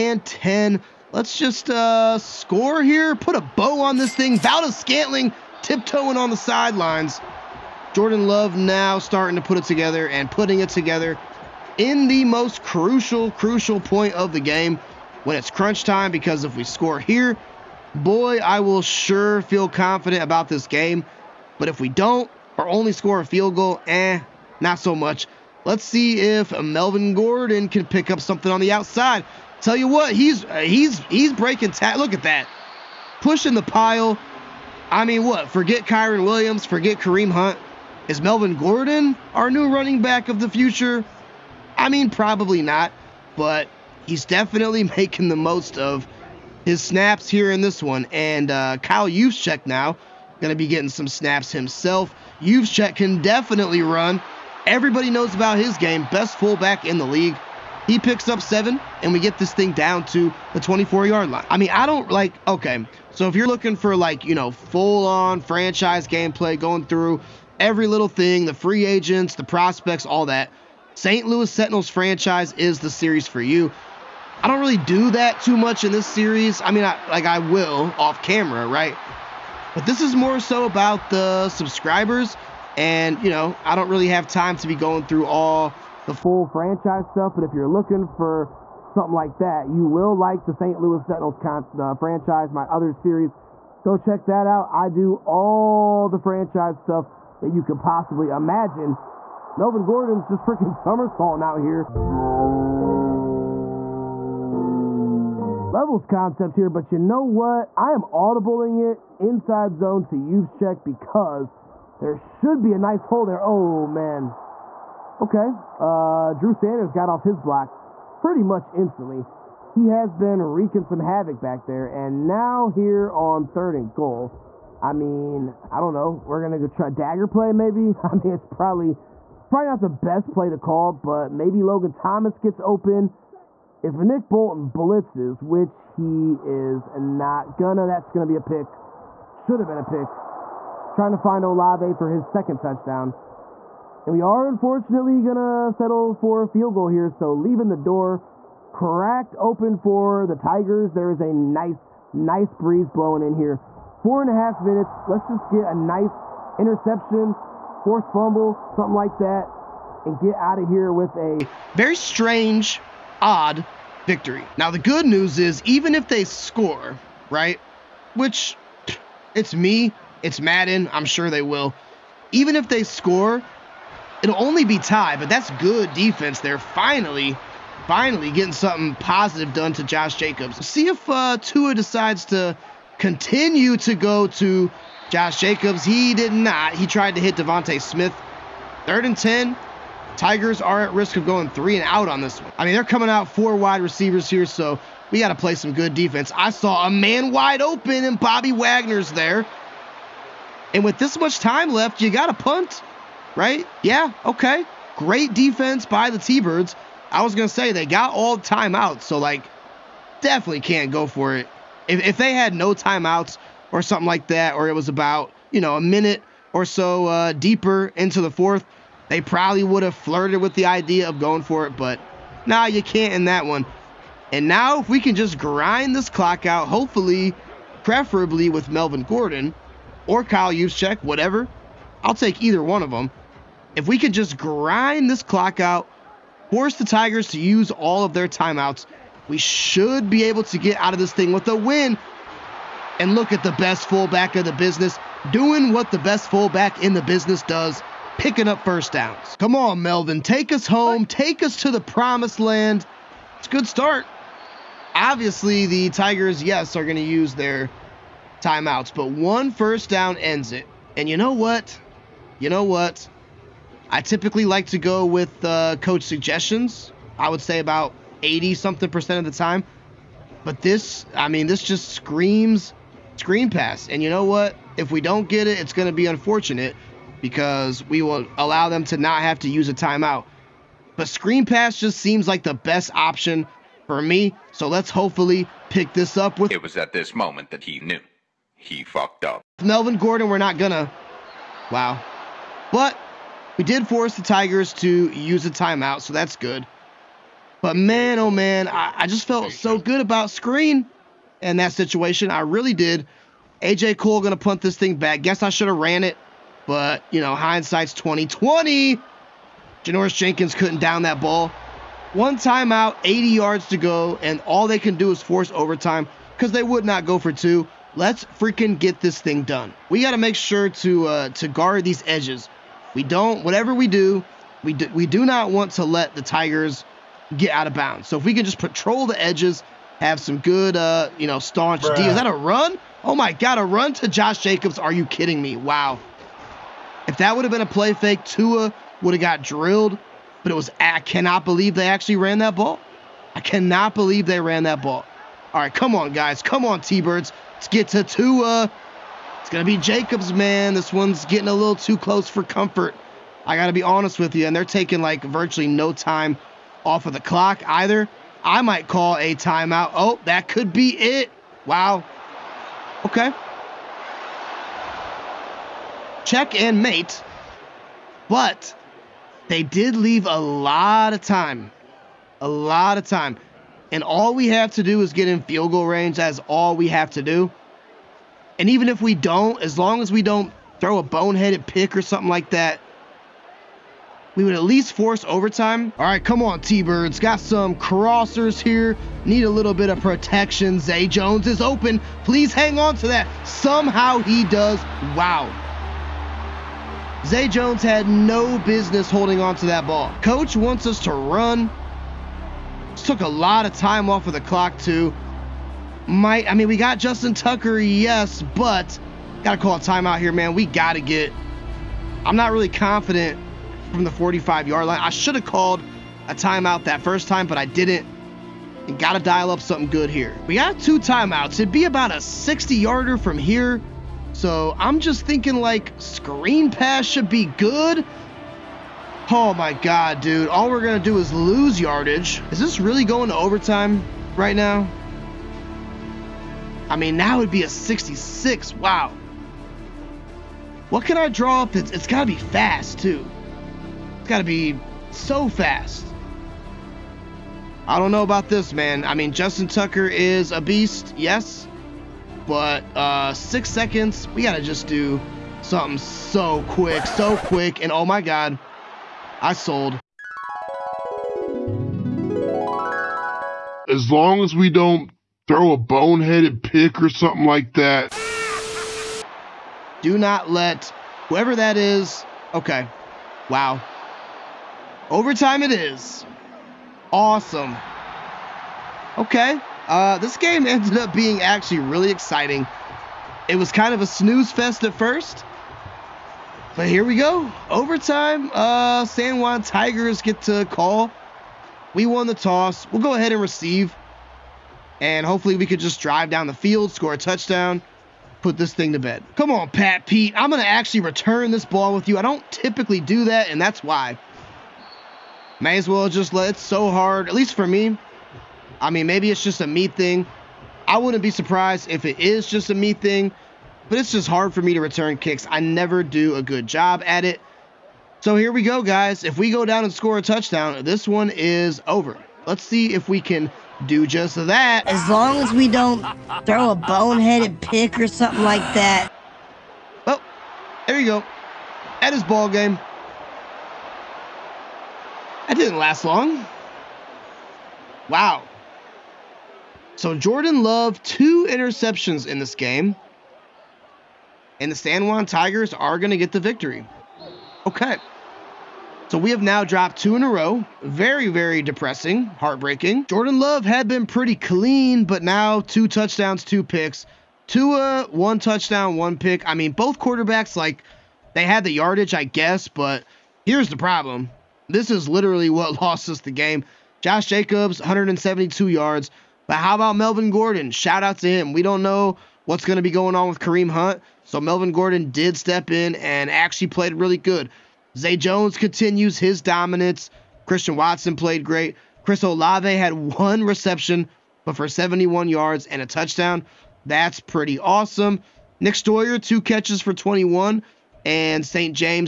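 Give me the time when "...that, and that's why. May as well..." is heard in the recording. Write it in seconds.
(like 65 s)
503 s.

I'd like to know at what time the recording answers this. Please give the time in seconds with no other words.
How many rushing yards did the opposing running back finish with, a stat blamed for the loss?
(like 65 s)
567 s.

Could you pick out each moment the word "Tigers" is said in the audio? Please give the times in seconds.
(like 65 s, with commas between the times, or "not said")
150 s, 190 s, 236 s, 255 s, 294 s, 326 s, 489 s, 545 s.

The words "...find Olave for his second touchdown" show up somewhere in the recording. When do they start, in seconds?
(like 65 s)
141 s.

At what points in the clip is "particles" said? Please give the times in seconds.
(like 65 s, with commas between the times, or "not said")
not said.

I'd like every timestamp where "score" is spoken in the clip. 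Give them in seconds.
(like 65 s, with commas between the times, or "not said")
2 s, 16 s, 22 s, 166 s, 172 s, 496 s, 519 s.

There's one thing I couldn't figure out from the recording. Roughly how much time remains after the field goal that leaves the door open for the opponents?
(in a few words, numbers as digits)
4 and a half minutes.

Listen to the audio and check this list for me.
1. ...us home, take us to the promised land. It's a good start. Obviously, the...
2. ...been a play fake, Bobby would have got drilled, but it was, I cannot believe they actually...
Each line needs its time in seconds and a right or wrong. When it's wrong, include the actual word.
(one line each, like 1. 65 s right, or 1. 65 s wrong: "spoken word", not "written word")
1. 250 s right
2. 337 s wrong: "Tua", not "Bobby".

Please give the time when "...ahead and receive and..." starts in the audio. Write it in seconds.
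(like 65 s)
493 s.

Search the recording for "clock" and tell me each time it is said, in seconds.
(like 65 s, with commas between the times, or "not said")
226 s, 235 s, 357 s, 404 s.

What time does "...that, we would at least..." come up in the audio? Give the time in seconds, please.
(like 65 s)
382 s.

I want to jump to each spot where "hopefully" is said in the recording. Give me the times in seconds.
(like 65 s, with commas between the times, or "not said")
226 s, 284 s, 495 s.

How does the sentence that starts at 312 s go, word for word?
One timeout, 80 yards to go, and all they can do is force overtime because they would not go for two.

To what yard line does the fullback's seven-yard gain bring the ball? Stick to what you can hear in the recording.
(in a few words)
24.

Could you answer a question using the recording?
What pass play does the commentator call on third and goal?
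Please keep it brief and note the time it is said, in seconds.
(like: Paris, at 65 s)
dagger, at 126 s.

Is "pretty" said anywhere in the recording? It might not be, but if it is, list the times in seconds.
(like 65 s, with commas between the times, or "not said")
118 s, 554 s, 587 s.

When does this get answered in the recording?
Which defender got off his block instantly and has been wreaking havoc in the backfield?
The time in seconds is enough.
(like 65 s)
116 s.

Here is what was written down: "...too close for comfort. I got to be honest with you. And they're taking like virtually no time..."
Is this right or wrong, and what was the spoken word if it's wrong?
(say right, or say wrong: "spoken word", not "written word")
right.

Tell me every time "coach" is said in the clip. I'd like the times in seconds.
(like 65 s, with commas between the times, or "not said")
265 s, 400 s.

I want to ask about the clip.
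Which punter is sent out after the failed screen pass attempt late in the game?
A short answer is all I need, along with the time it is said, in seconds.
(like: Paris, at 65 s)
AJ Cole, at 303 s.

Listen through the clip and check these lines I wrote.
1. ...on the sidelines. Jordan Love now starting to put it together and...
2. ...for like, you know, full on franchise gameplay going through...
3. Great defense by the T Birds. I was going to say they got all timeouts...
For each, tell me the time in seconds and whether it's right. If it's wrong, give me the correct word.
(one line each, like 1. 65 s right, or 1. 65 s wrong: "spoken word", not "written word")
1. 6 s right
2. 63 s right
3. 204 s right.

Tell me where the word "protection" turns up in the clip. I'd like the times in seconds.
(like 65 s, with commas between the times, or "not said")
390 s.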